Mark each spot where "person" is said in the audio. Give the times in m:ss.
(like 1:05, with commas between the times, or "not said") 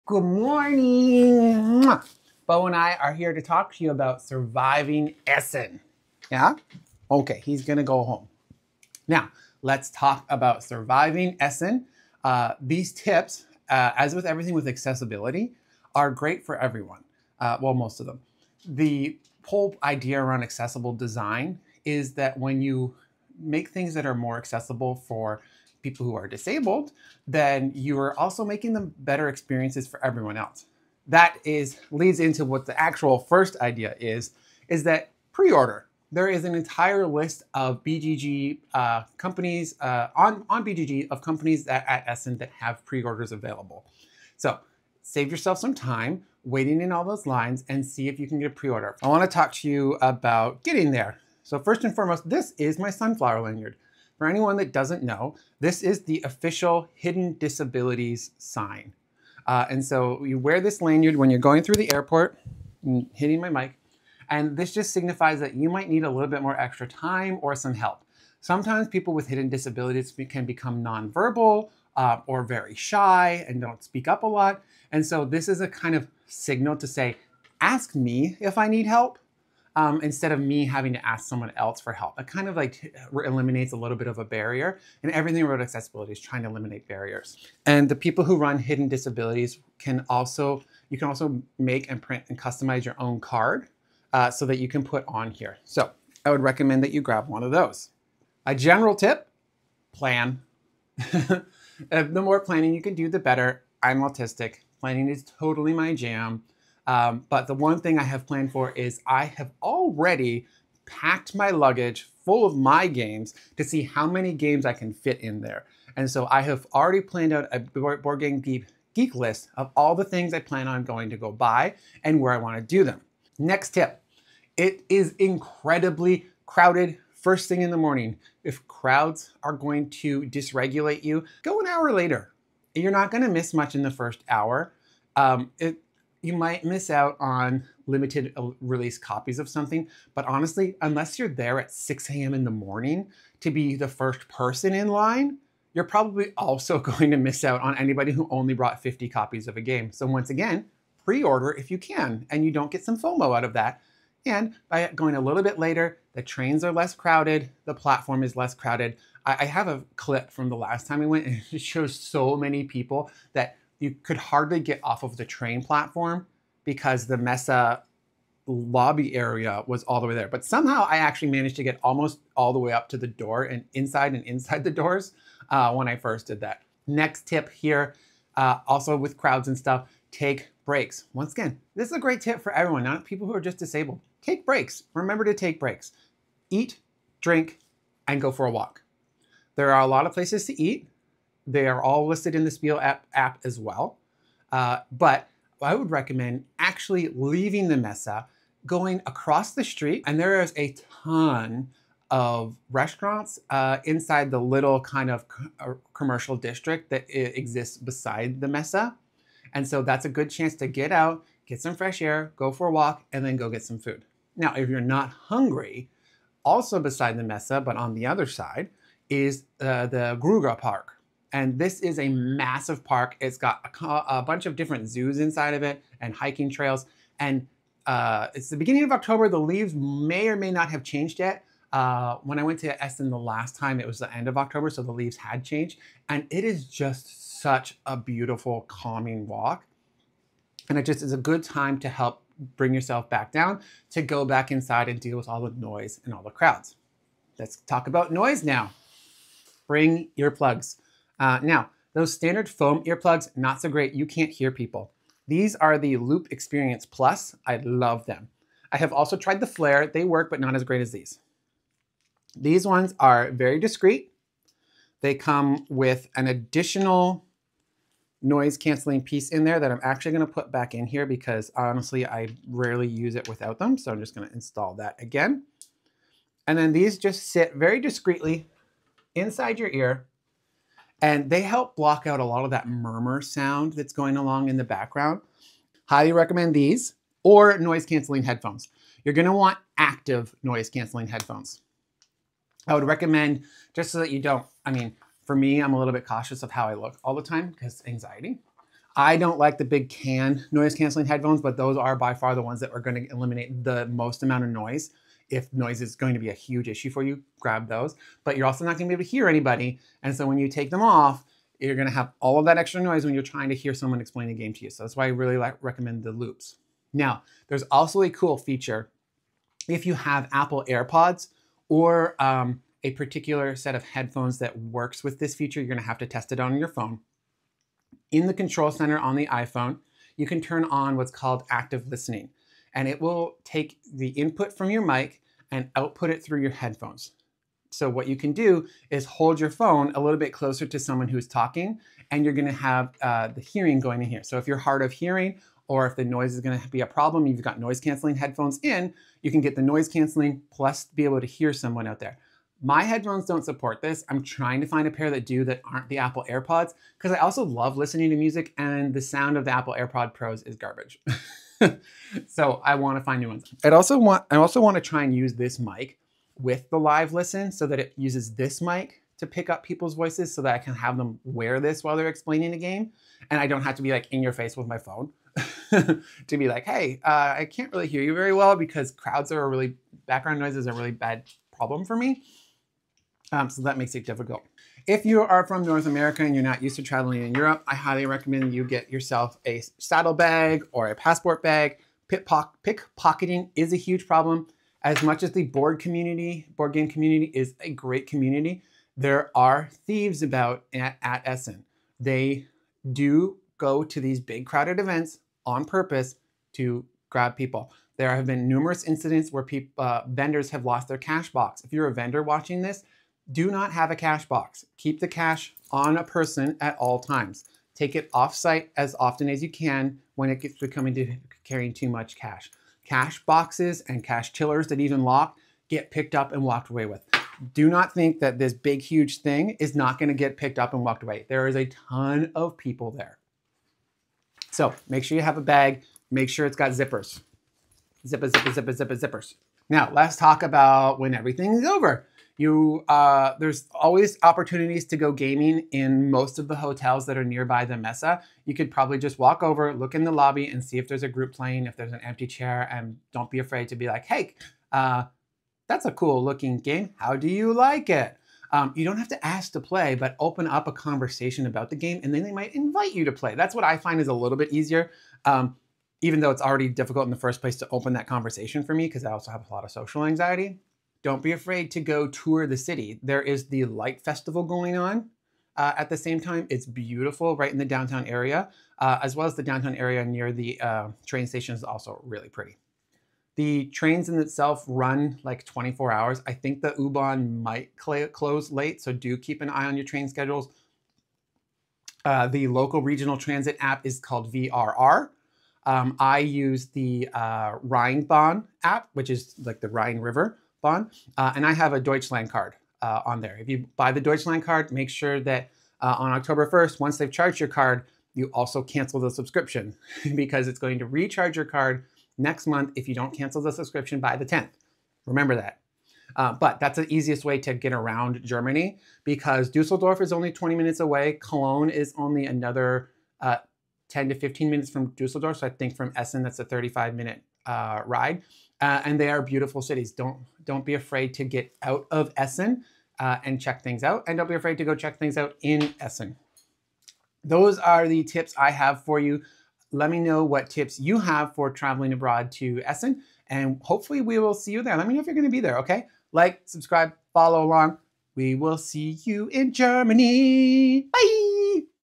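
2:24, 6:56.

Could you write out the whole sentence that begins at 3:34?
Now, if you're not hungry, also beside the Messe, but on the other side, is uh, the Grugapark.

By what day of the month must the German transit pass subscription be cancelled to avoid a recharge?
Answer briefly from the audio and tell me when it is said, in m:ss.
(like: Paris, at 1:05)
10th, at 8:34.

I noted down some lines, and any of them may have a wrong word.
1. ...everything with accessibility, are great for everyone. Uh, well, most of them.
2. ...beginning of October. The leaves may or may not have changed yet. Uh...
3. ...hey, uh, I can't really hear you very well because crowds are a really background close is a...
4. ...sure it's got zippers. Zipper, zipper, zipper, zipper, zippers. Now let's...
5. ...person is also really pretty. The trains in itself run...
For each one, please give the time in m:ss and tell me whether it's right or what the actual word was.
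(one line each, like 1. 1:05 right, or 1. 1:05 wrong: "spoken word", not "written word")
1. 0:14 right
2. 3:48 right
3. 6:16 wrong: "noise", not "close"
4. 7:16 right
5. 8:01 wrong: "station", not "person".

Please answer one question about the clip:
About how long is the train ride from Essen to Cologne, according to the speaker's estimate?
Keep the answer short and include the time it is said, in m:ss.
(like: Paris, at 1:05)
35 minutes, at 8:46.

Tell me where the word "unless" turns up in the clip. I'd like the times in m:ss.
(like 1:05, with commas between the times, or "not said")
2:20.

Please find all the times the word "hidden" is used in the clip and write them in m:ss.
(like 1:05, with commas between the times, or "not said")
0:56, 1:09, 1:28.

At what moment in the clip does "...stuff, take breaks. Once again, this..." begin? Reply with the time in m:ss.
2:59.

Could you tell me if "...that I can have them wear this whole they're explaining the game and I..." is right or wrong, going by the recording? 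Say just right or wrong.
wrong.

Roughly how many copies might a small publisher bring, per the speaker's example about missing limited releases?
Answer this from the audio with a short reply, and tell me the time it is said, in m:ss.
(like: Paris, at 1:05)
50, at 2:28.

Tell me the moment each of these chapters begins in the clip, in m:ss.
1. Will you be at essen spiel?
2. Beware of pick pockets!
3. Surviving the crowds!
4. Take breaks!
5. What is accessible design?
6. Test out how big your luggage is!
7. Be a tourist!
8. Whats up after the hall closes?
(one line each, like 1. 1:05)
1. 9:00
2. 6:25
3. 2:01
4. 2:57
5. 0:15
6. 1:48
7. 7:51
8. 7:19.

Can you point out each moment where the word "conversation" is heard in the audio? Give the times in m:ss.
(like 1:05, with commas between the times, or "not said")
7:40, 7:48.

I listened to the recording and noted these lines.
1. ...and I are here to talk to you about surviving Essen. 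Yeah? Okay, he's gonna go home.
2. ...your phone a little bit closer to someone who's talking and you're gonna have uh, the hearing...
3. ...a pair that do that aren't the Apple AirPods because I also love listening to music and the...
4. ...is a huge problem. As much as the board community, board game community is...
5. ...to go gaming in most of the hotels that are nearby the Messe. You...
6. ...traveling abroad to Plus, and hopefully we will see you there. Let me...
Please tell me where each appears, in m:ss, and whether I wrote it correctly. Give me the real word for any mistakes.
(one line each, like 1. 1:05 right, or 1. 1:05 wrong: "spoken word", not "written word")
1. 0:02 right
2. 5:39 right
3. 5:54 right
4. 6:33 right
5. 7:24 right
6. 9:01 wrong: "Essen", not "Plus".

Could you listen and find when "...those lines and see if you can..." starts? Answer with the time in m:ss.
0:47.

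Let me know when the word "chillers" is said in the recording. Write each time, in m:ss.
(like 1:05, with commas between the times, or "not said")
7:04.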